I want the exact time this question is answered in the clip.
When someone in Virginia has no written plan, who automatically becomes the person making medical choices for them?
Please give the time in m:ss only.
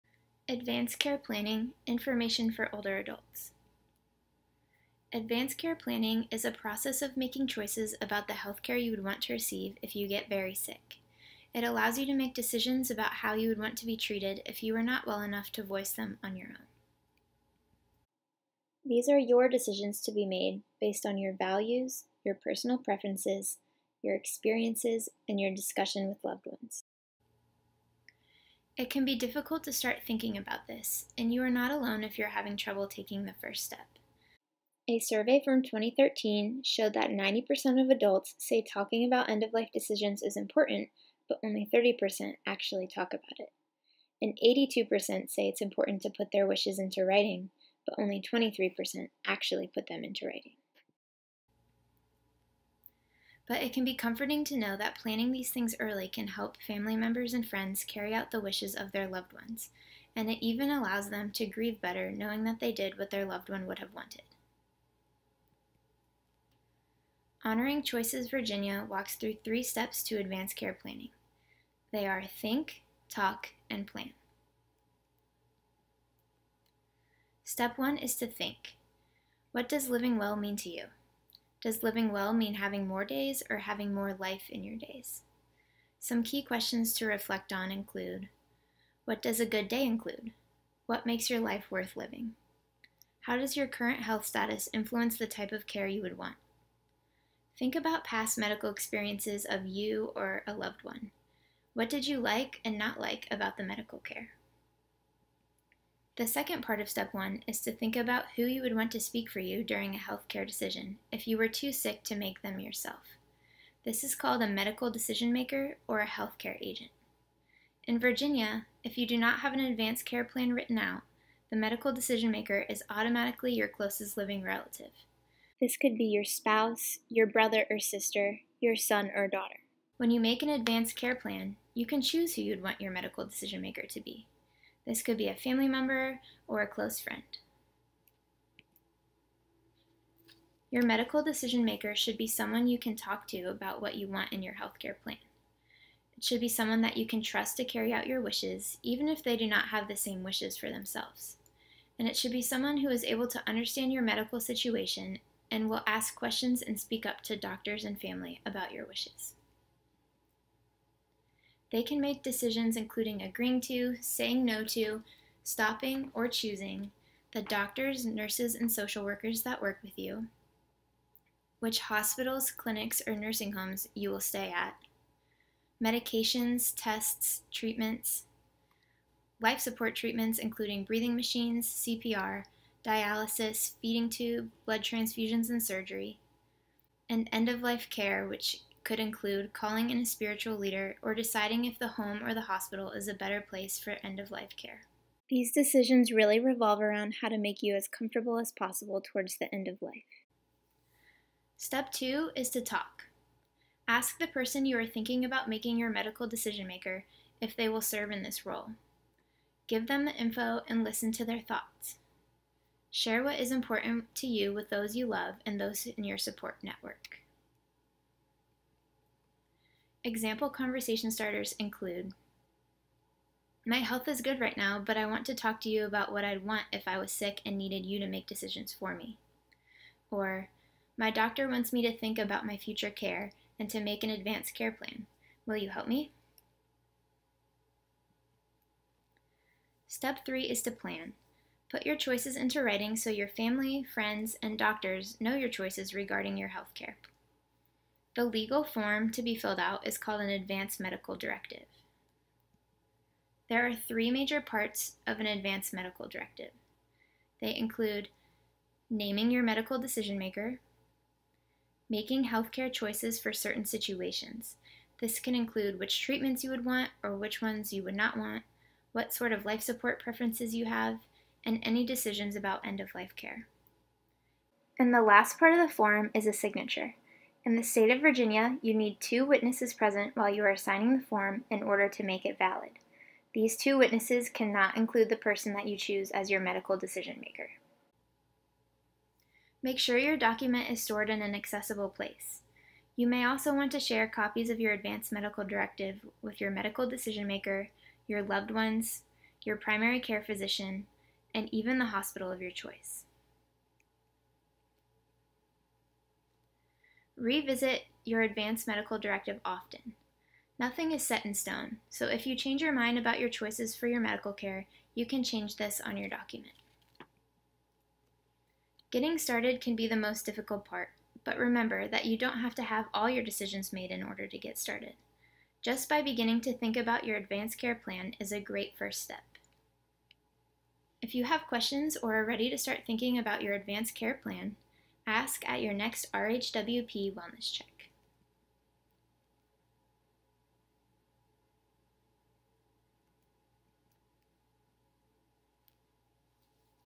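2:03.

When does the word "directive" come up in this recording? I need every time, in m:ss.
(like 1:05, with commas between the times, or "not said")
4:11, 4:16, 4:55, 5:08.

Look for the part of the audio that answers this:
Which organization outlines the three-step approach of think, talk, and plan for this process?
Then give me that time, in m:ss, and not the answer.
1:07.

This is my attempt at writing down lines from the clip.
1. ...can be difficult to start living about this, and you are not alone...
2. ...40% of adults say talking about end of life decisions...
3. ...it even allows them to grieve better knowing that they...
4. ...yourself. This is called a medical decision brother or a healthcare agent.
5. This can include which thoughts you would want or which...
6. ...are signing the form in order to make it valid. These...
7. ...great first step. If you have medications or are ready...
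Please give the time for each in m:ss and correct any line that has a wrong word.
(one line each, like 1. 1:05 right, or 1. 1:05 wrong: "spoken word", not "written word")
1. 0:28 wrong: "thinking", not "living"
2. 0:37 wrong: "90", not "40"
3. 1:00 right
4. 1:52 wrong: "maker", not "brother"
5. 4:24 wrong: "treatments", not "thoughts"
6. 4:40 right
7. 5:28 wrong: "questions", not "medications".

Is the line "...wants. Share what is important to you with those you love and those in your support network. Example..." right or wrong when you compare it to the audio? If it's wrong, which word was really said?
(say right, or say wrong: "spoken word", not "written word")
wrong: "thoughts", not "wants".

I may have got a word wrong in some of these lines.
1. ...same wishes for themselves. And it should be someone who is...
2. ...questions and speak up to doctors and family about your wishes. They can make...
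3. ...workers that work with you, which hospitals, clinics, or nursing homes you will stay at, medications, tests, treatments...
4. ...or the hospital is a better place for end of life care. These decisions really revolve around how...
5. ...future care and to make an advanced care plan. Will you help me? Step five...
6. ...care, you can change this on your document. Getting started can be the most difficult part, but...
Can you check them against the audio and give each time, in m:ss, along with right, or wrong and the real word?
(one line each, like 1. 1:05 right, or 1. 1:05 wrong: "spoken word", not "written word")
1. 2:29 right
2. 2:36 right
3. 2:49 right
4. 3:12 right
5. 3:52 wrong: "three", not "five"
6. 5:14 right.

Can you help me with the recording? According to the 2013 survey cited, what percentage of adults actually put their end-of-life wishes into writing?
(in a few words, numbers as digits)
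23%.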